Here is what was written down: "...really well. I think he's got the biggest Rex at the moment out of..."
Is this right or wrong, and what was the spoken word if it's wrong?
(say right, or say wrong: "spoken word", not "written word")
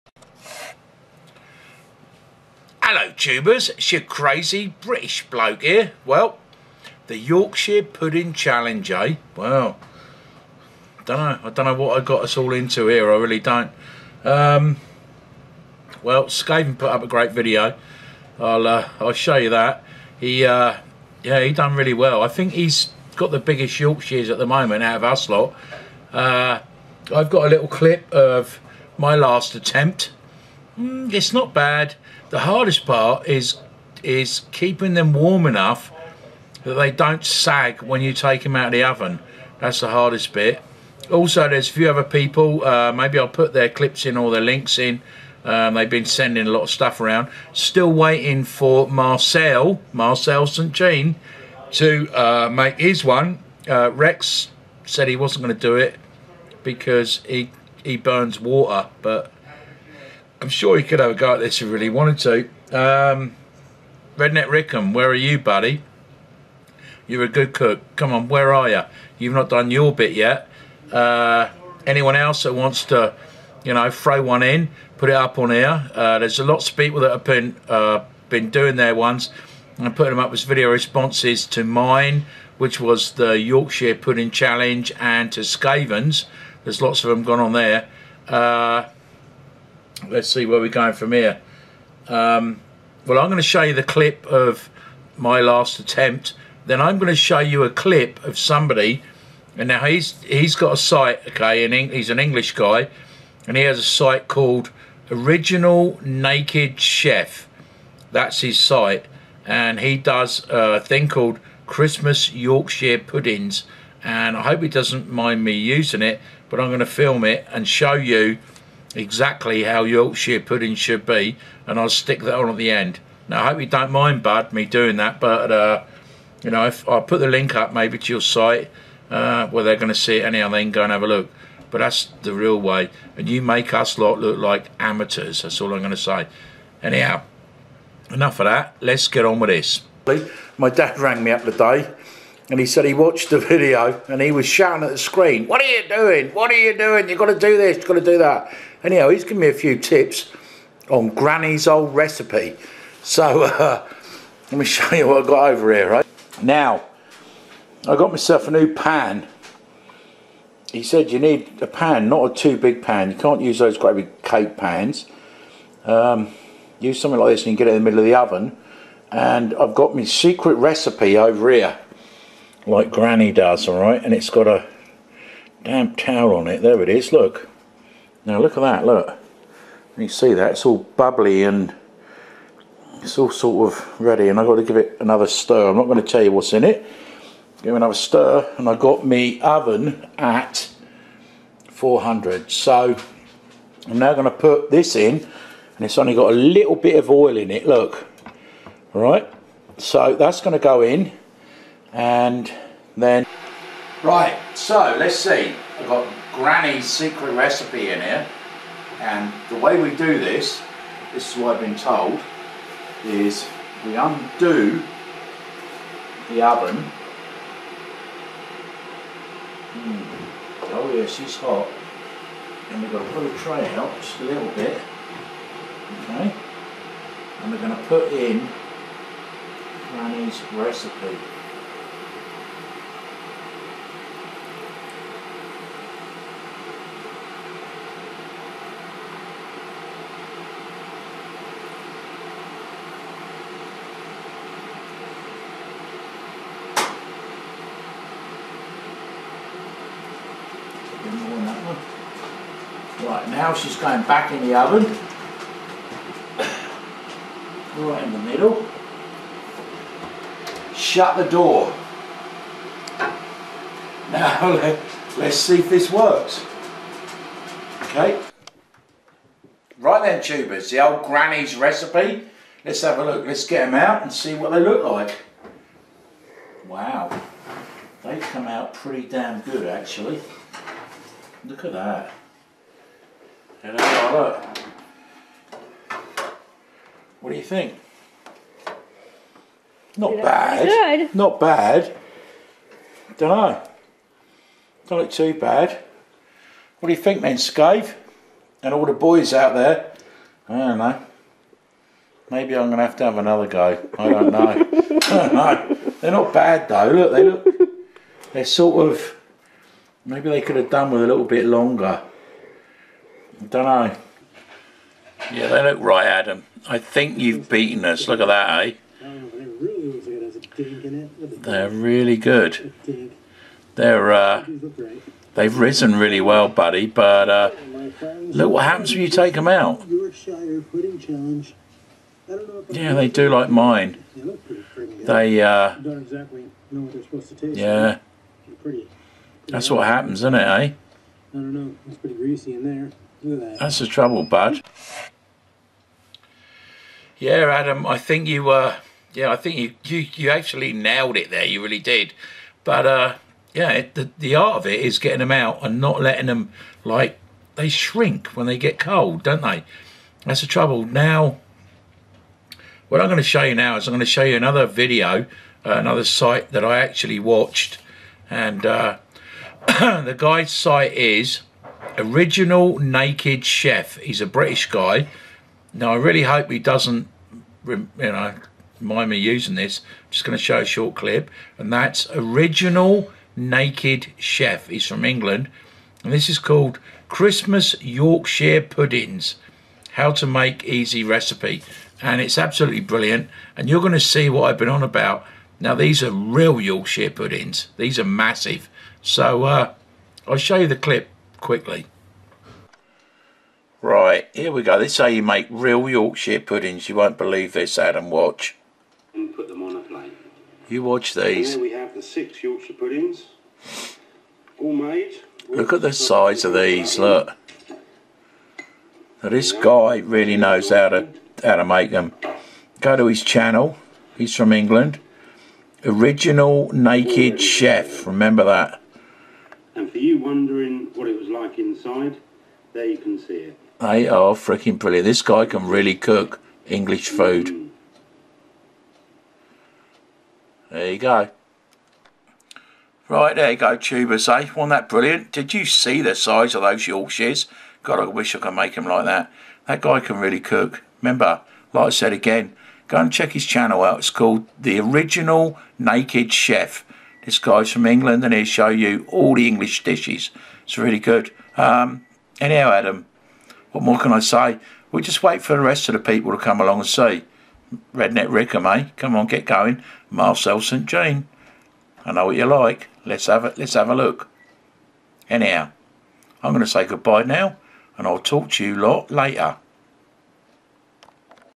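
wrong: "Yorkshires", not "Rex".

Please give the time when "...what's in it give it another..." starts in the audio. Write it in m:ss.
3:06.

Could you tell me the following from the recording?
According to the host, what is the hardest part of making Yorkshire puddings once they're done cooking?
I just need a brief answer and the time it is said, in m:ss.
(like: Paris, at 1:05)
Keeping them warm enough, at 0:34.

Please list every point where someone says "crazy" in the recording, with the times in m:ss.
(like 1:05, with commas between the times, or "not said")
0:04.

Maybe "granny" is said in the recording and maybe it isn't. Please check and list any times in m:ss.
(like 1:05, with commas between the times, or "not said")
2:31, 2:52, 3:26, 3:49, 4:31.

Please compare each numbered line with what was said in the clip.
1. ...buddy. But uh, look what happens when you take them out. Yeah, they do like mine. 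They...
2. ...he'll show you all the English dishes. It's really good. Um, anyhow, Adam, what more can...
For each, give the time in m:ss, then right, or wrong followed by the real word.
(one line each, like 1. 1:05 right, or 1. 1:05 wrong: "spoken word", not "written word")
1. 5:26 right
2. 7:38 right.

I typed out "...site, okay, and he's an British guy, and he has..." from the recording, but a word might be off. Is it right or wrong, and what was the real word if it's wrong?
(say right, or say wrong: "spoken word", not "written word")
wrong: "English", not "British".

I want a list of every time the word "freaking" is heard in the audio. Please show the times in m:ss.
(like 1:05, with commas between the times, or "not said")
7:14.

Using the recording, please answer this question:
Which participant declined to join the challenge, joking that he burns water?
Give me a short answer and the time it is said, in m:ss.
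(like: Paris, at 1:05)
Rex, at 0:53.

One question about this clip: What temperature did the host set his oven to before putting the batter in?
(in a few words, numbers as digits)
400.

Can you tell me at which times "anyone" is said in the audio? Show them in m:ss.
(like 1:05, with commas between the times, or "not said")
1:11.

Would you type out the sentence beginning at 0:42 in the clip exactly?
Uh, maybe I'll put their clips in or their links in.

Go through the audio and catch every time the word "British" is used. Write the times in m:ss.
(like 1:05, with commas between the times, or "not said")
0:04, 6:14.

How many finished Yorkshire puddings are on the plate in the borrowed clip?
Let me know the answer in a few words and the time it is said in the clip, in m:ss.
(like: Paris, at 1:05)
6, at 6:52.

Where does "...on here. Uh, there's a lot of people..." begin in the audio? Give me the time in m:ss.
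1:15.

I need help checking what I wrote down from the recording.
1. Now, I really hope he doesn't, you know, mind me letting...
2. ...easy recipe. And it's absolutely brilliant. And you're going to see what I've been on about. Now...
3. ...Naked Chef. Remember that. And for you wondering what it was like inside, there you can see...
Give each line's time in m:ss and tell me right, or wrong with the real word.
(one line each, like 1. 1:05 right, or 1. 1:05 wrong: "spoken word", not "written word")
1. 6:15 wrong: "using", not "letting"
2. 6:30 right
3. 7:06 right.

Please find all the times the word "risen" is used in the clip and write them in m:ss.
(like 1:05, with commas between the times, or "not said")
5:25.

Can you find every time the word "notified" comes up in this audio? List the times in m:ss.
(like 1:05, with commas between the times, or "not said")
not said.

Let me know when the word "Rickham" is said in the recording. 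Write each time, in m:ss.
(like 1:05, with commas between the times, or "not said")
1:04, 7:48.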